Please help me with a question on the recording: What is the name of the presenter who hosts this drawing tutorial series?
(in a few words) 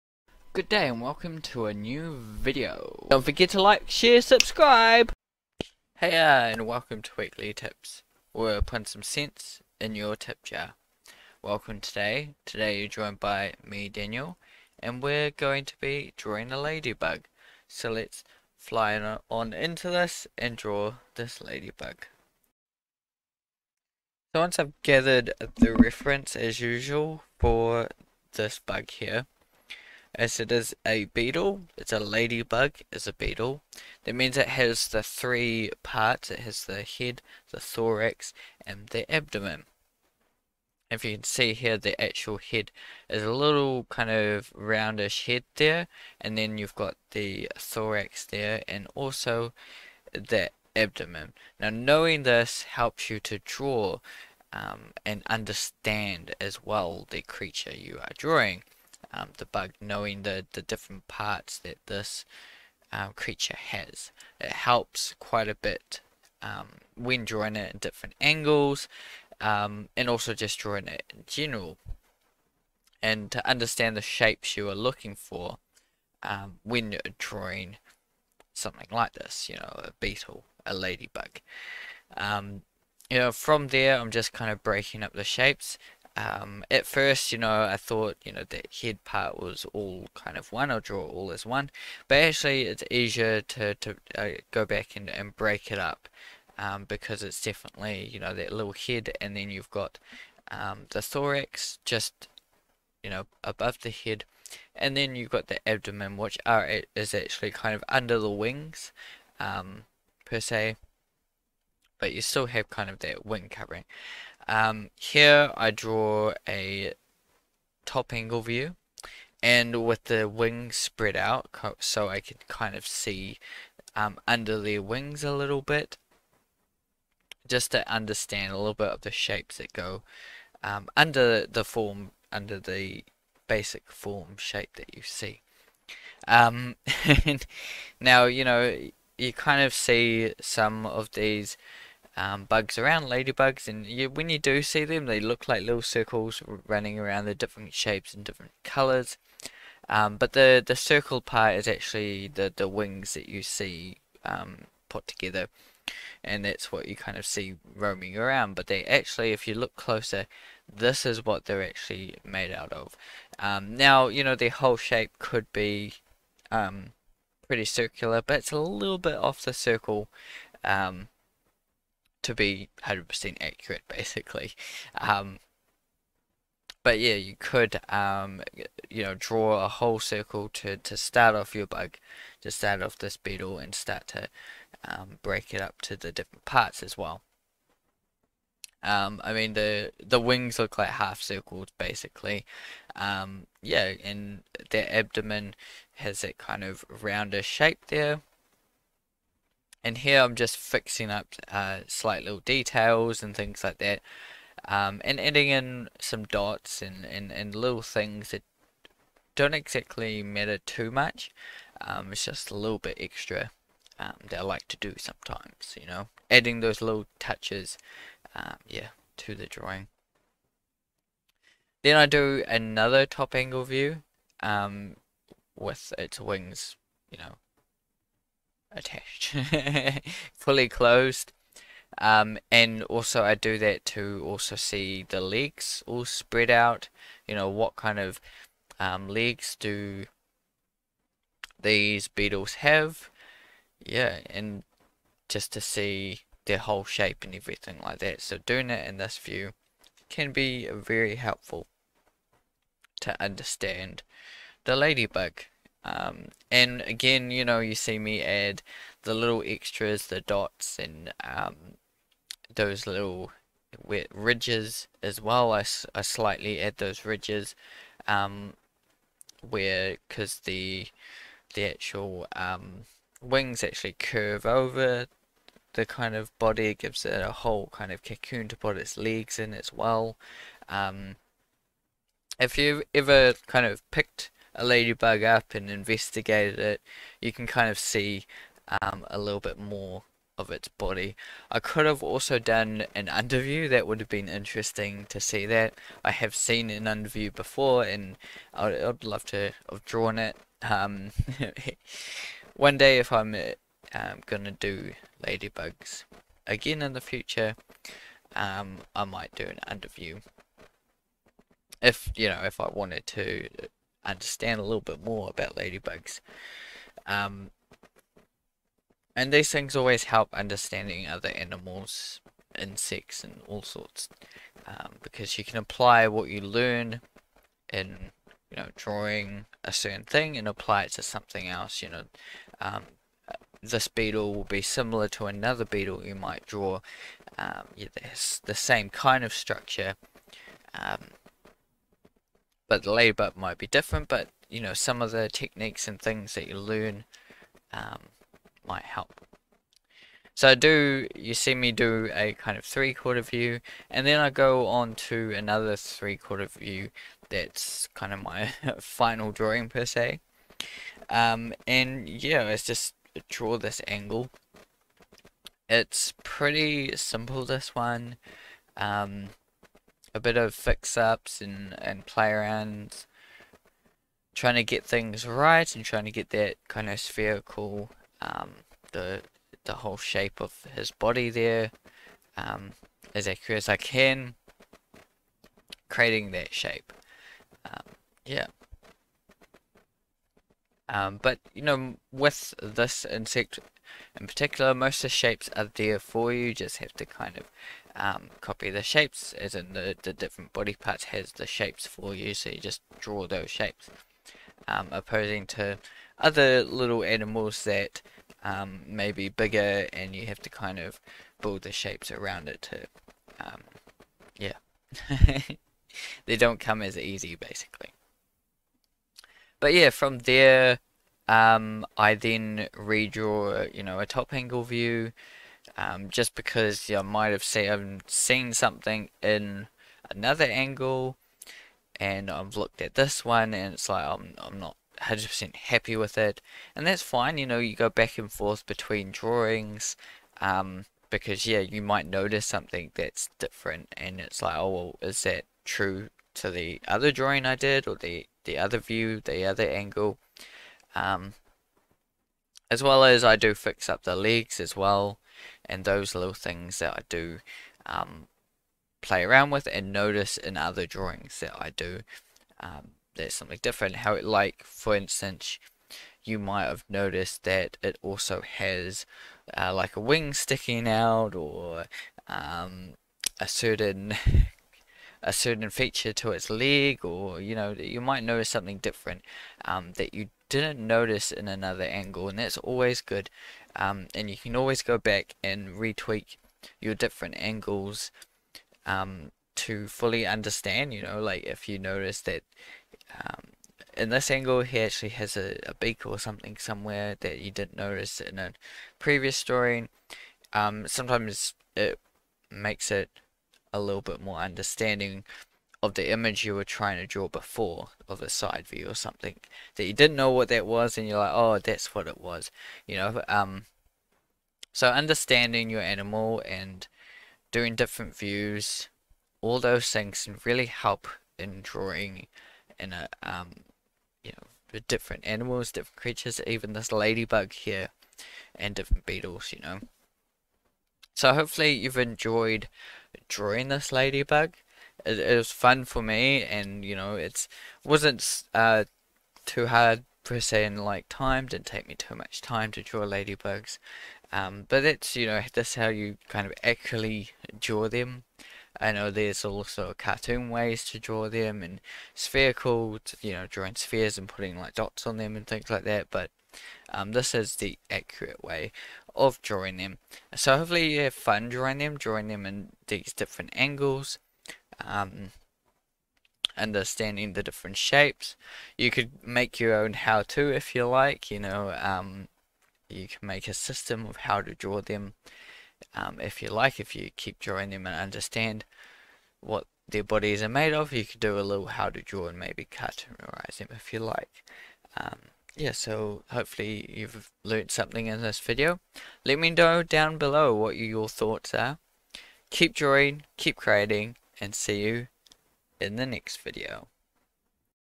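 Daniel.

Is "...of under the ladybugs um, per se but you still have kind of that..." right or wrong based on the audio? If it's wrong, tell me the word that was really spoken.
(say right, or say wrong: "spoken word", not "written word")
wrong: "wings", not "ladybugs".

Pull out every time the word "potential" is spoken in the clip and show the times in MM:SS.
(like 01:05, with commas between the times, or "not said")
not said.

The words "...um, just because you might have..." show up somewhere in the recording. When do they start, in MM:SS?
07:05.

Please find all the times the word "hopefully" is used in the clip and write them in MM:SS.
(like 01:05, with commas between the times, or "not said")
08:51, 09:20, 09:46.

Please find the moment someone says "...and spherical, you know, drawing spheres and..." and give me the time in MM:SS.
09:11.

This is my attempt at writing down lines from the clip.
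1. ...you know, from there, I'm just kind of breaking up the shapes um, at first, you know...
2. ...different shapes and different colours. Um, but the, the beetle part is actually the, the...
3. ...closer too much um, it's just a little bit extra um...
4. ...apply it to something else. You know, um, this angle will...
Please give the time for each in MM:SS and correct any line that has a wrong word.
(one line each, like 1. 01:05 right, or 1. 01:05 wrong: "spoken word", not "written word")
1. 01:23 right
2. 02:27 wrong: "circle", not "beetle"
3. 03:30 wrong: "matter", not "closer"
4. 05:30 wrong: "beetle", not "angle".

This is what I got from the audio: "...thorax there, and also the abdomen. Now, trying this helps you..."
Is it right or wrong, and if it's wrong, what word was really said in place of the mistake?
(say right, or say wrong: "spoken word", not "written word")
wrong: "knowing", not "trying".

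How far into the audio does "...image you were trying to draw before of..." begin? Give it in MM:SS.
08:26.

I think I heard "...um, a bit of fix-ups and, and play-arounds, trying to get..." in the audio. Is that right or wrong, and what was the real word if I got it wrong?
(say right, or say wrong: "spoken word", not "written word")
right.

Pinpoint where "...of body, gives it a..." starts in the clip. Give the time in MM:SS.
04:36.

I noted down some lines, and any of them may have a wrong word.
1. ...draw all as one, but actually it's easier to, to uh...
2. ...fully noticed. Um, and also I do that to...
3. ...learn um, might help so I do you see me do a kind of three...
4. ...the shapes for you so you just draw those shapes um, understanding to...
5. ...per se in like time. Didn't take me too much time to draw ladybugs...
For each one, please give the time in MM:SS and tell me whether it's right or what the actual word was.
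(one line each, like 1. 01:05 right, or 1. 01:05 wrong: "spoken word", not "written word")
1. 01:30 right
2. 03:50 wrong: "closed", not "noticed"
3. 05:46 right
4. 06:41 wrong: "opposing", not "understanding"
5. 09:00 right.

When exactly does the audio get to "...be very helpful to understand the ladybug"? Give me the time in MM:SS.
04:10.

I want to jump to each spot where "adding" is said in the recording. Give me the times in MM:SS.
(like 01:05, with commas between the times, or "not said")
03:25, 03:36.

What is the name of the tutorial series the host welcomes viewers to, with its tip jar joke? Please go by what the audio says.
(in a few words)
Weekly Tips.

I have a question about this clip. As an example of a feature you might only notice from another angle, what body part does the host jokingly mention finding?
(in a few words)
A beak.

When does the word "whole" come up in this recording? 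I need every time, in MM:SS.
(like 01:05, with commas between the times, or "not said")
02:44, 02:59, 04:06, 04:37, 06:19.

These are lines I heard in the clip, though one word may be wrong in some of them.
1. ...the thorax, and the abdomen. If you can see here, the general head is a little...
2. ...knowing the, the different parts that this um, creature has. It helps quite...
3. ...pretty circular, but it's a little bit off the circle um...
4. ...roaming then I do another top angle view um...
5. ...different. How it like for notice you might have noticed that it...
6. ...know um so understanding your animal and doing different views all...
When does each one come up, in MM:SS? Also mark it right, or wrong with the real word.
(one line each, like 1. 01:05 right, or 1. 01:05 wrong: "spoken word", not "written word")
1. 00:37 wrong: "actual", not "general"
2. 00:59 right
3. 02:47 right
4. 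03:39 wrong: "drawing", not "roaming"
5. 07:43 wrong: "instance", not "notice"
6. 08:32 right.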